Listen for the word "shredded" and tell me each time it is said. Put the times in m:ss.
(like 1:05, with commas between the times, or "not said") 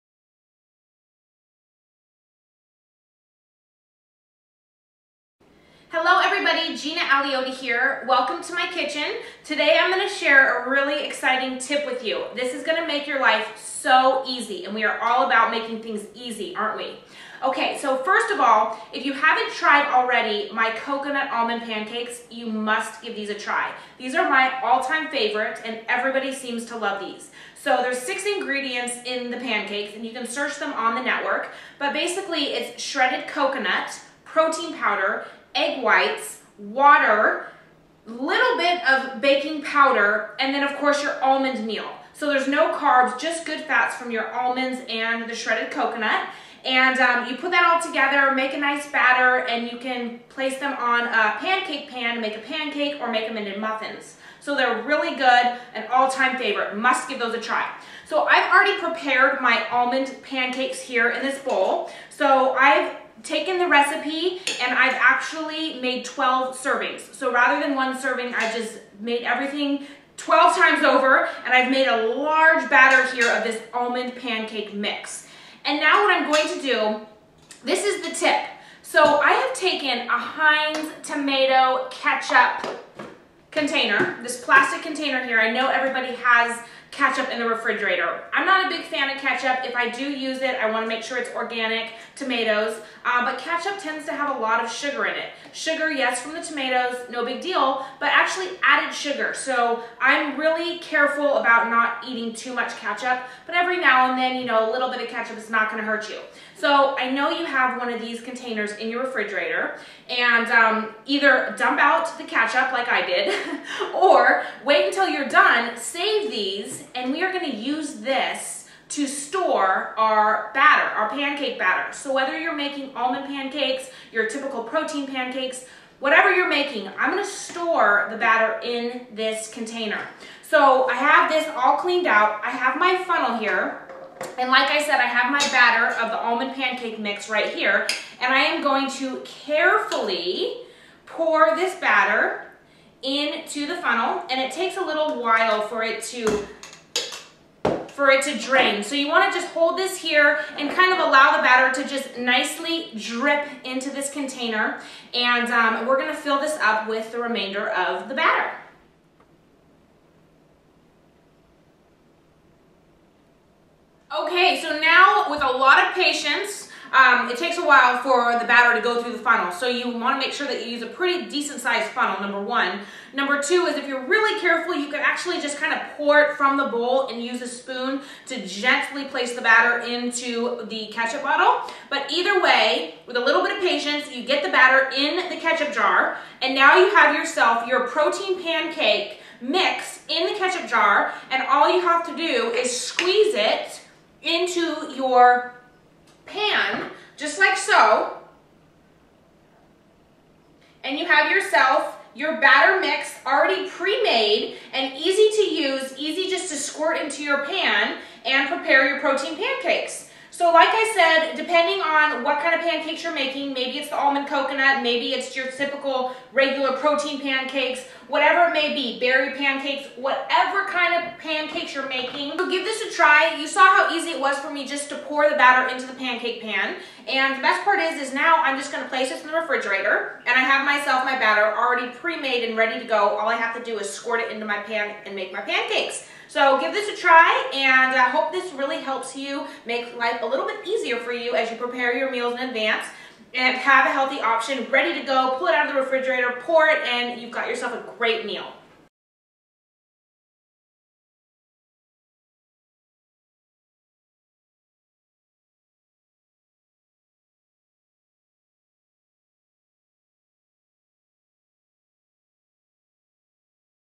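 0:32, 0:45.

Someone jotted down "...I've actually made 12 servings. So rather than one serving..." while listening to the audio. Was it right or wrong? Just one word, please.
right.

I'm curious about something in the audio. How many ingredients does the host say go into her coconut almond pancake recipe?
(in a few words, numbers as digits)
6.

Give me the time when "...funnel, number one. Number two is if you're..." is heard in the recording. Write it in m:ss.
2:51.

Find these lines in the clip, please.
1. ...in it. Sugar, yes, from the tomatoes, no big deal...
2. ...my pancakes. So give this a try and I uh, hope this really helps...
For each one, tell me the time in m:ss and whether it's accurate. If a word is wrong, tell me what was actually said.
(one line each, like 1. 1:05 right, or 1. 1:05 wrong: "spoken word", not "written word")
1. 1:35 right
2. 3:55 right.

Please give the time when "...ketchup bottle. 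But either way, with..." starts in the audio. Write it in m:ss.
3:00.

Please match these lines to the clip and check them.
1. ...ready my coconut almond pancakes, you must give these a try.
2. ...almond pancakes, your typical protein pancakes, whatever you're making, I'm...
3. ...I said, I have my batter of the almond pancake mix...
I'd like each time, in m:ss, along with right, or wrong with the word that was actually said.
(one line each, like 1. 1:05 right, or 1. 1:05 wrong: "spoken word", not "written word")
1. 0:19 wrong: "already", not "ready"
2. 2:02 right
3. 2:14 right.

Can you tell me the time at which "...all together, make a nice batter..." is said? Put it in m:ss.
0:47.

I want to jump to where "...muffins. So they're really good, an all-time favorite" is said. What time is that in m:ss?
0:53.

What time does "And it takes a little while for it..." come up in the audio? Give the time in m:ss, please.
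2:24.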